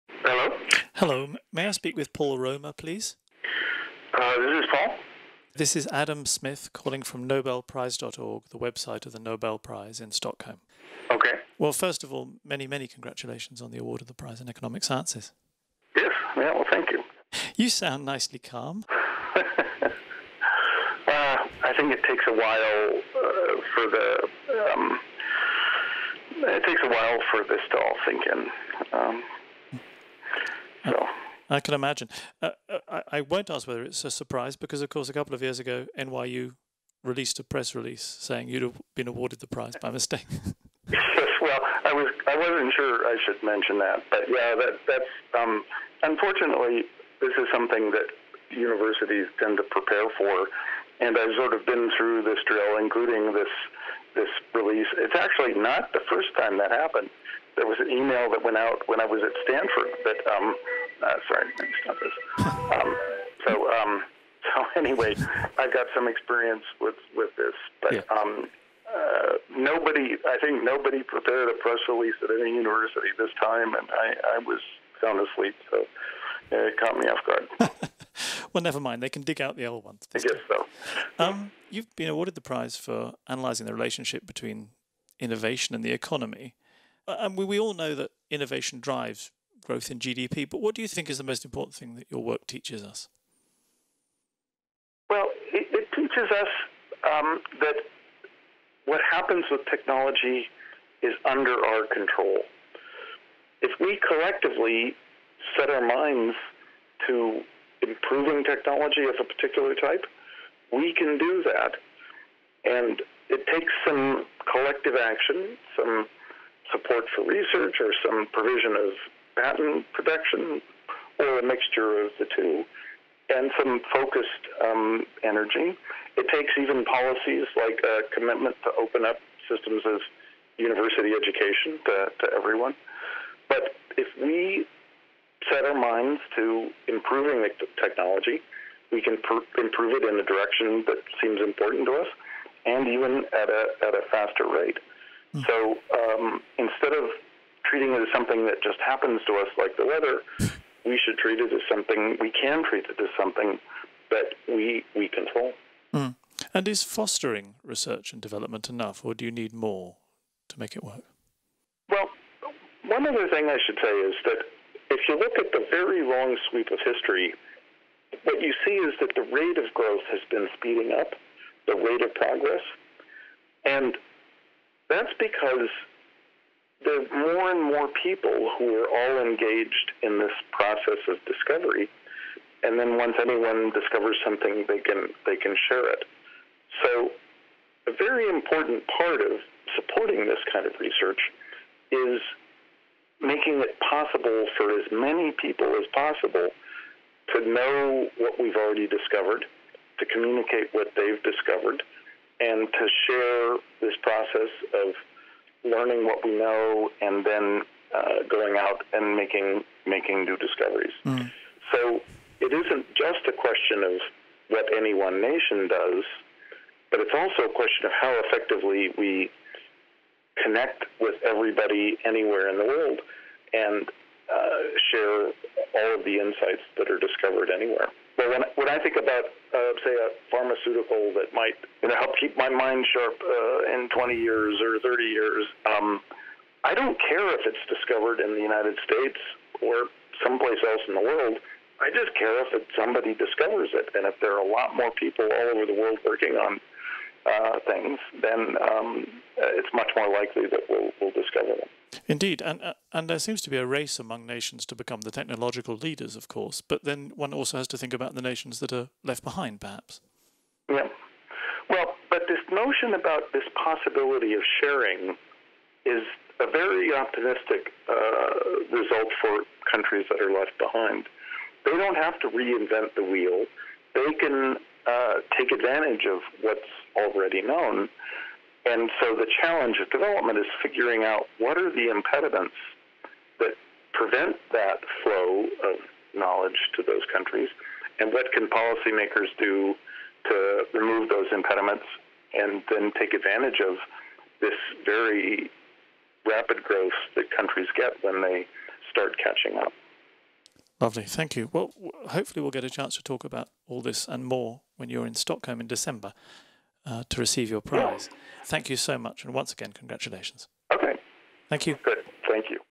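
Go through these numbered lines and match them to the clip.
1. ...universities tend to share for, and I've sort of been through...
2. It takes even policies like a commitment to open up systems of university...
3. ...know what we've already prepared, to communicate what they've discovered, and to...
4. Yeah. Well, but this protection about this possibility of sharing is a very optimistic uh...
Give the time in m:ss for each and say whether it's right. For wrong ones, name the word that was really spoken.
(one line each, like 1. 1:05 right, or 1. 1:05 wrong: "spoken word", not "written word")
1. 0:48 wrong: "prepare", not "share"
2. 2:06 right
3. 3:17 wrong: "discovered", not "prepared"
4. 4:20 wrong: "notion", not "protection".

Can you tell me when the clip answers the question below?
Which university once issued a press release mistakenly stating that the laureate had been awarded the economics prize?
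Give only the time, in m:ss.
0:35.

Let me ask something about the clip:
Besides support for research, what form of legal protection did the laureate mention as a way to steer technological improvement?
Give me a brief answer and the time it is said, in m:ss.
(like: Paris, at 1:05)
patent protection, at 1:59.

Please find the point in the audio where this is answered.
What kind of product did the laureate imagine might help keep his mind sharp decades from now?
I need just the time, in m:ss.
3:50.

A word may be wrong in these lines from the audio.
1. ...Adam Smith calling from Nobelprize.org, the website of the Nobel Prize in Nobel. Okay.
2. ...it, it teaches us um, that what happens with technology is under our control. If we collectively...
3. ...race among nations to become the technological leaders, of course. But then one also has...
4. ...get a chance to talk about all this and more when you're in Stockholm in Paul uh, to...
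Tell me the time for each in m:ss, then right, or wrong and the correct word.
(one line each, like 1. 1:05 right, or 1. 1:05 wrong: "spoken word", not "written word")
1. 0:05 wrong: "Stockholm", not "Nobel"
2. 1:35 right
3. 4:13 right
4. 5:02 wrong: "December", not "Paul".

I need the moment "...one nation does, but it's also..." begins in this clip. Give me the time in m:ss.
3:34.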